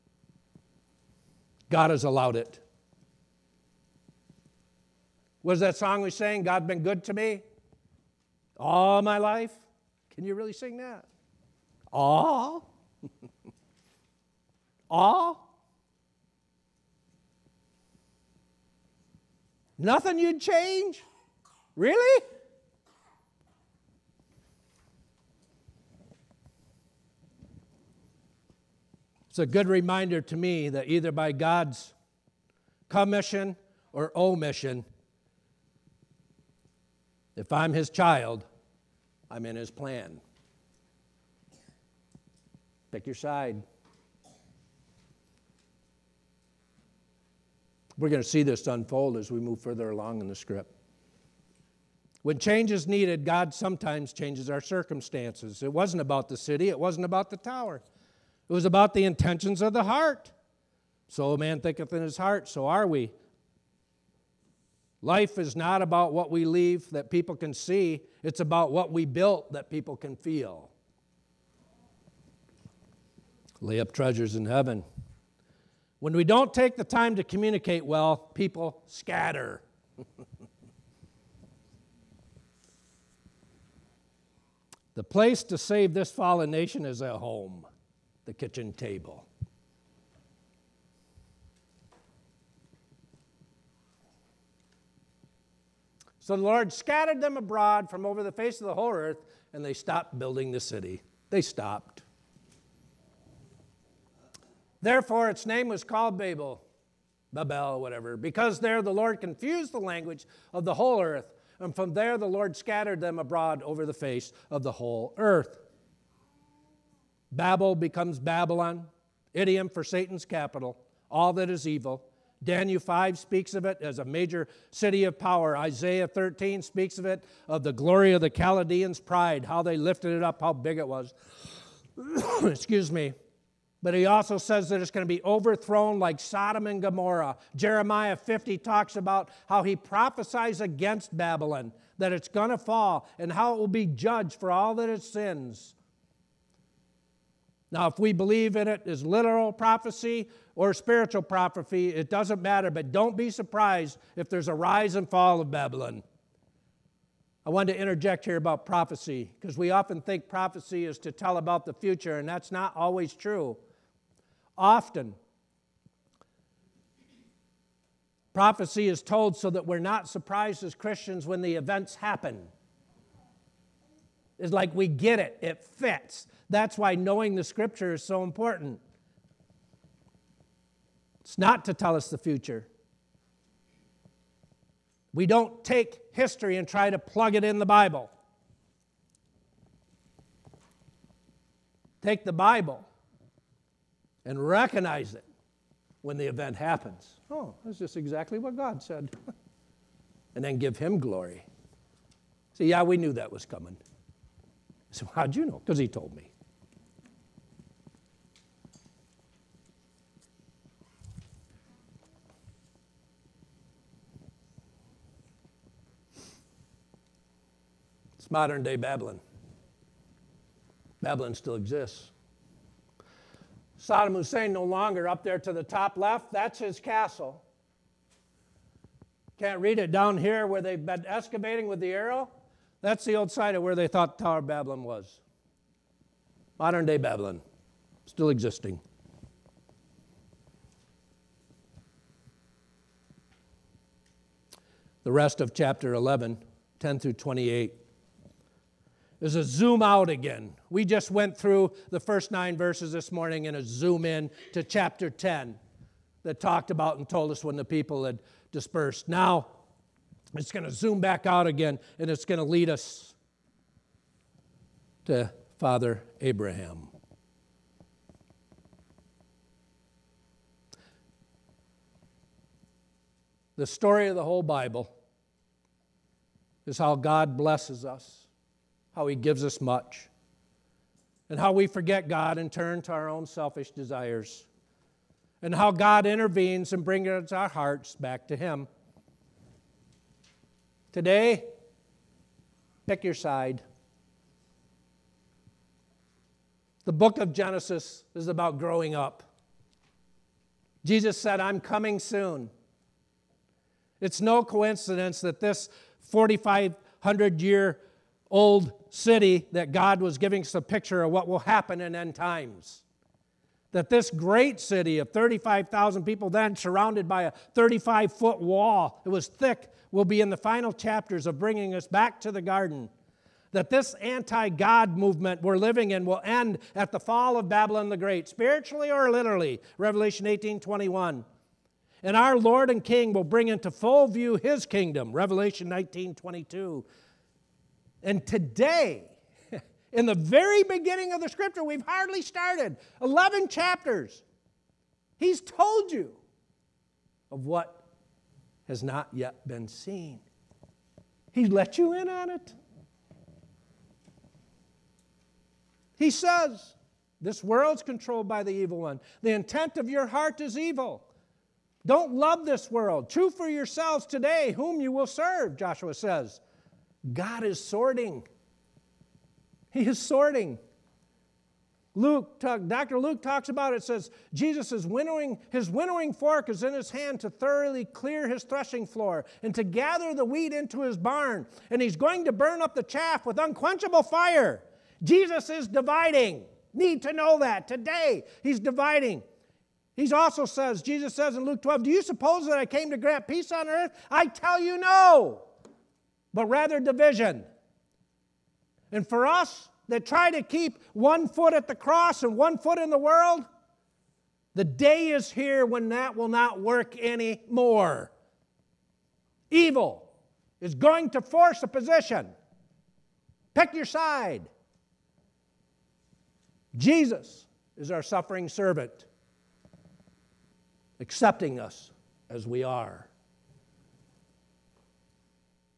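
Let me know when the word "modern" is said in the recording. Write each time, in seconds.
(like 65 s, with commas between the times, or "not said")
218 s, 236 s.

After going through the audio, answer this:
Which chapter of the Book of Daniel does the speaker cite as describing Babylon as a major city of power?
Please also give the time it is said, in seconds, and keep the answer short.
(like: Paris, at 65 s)
Daniel 5, at 122 s.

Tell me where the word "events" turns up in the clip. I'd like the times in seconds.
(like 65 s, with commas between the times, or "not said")
171 s, 196 s.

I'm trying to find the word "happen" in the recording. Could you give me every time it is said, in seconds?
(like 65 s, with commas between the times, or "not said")
171 s, 196 s, 311 s.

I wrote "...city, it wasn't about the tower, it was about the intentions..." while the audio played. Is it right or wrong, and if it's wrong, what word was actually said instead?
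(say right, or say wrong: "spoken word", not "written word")
right.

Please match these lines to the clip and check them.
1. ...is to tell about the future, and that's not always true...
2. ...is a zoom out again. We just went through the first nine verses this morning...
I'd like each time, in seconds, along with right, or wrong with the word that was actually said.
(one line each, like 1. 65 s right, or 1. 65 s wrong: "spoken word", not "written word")
1. 160 s right
2. 249 s right.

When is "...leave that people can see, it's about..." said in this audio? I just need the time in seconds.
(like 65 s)
66 s.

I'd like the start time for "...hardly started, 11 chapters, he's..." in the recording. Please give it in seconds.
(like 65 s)
341 s.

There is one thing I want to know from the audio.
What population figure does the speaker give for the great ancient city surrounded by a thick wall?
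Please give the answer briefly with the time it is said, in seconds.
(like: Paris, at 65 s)
35,000, at 315 s.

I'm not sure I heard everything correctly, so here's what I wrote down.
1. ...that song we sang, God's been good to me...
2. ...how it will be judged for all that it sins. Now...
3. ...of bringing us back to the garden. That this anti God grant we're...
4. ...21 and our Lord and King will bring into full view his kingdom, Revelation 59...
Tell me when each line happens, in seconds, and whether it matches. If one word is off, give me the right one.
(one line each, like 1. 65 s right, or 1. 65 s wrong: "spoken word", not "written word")
1. 5 s right
2. 143 s right
3. 321 s wrong: "movement", not "grant"
4. 330 s wrong: "19", not "59".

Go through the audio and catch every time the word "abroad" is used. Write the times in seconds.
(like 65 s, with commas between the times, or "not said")
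97 s, 113 s.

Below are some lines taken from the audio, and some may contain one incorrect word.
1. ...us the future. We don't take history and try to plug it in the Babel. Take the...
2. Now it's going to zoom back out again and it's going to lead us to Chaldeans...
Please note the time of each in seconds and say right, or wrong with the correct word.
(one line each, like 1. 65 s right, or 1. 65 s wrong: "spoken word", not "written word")
1. 181 s wrong: "Bible", not "Babel"
2. 259 s wrong: "Father", not "Chaldeans".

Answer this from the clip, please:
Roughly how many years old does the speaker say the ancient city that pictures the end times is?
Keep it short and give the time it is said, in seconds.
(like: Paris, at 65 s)
4,500, at 306 s.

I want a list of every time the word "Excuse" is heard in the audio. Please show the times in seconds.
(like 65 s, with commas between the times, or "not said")
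132 s.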